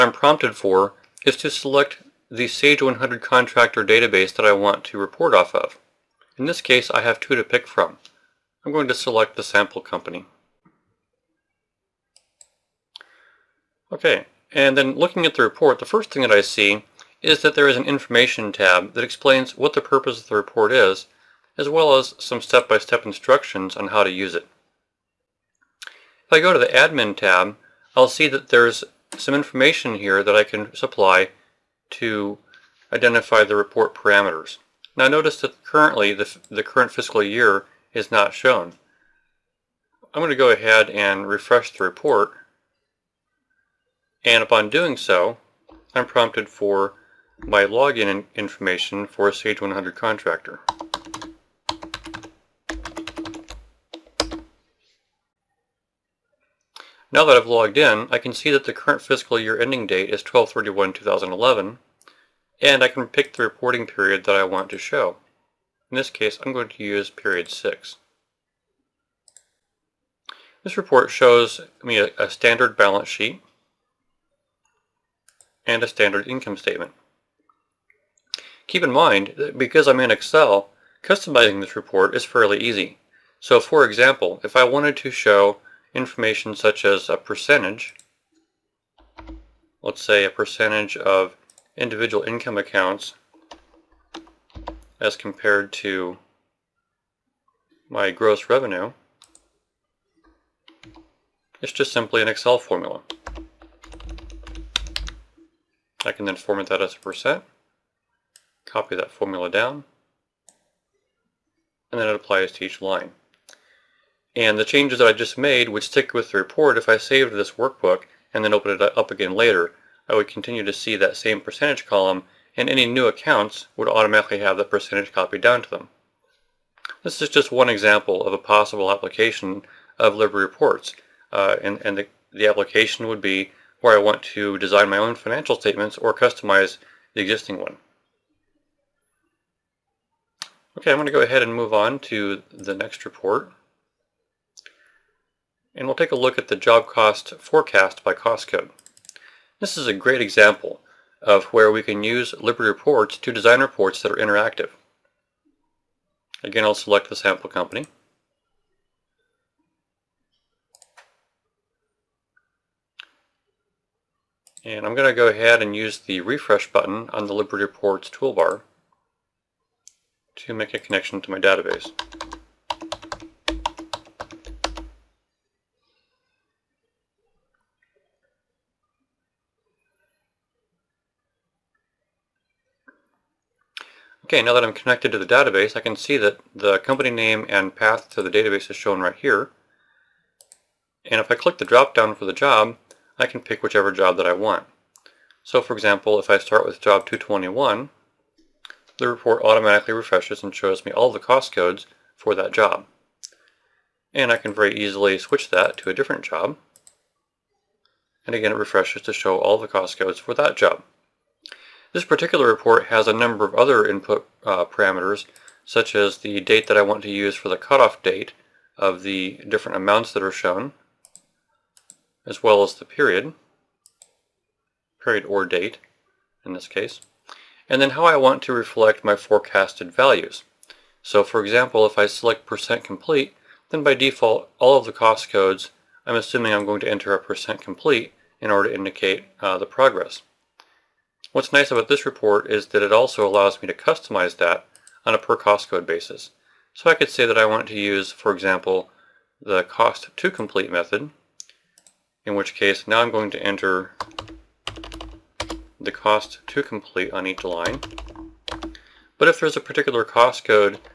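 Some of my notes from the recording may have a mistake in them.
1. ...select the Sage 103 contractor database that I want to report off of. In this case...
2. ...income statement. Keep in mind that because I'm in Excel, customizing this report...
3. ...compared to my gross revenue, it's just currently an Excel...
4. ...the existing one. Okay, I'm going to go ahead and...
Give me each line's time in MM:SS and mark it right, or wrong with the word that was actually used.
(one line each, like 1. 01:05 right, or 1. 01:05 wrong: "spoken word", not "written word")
1. 00:01 wrong: "100", not "103"
2. 01:16 right
3. 01:35 wrong: "simply", not "currently"
4. 02:17 right.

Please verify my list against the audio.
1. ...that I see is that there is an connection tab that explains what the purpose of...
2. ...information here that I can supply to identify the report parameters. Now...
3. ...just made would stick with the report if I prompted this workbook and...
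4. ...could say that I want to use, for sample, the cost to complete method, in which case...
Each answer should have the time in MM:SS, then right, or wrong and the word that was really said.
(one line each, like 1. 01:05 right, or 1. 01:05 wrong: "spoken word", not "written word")
1. 00:16 wrong: "information", not "connection"
2. 00:29 right
3. 01:55 wrong: "saved", not "prompted"
4. 04:06 wrong: "example", not "sample".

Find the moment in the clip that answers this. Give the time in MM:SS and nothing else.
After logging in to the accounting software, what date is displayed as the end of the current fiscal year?
01:00.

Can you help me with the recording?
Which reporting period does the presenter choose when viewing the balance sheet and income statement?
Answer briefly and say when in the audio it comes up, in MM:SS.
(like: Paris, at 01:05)
Period 6, at 01:07.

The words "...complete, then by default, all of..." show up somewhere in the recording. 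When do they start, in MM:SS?
03:52.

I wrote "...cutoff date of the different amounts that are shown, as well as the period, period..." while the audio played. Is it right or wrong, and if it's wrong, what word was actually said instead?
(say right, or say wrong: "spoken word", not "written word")
right.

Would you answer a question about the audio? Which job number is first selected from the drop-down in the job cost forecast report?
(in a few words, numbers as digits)
221.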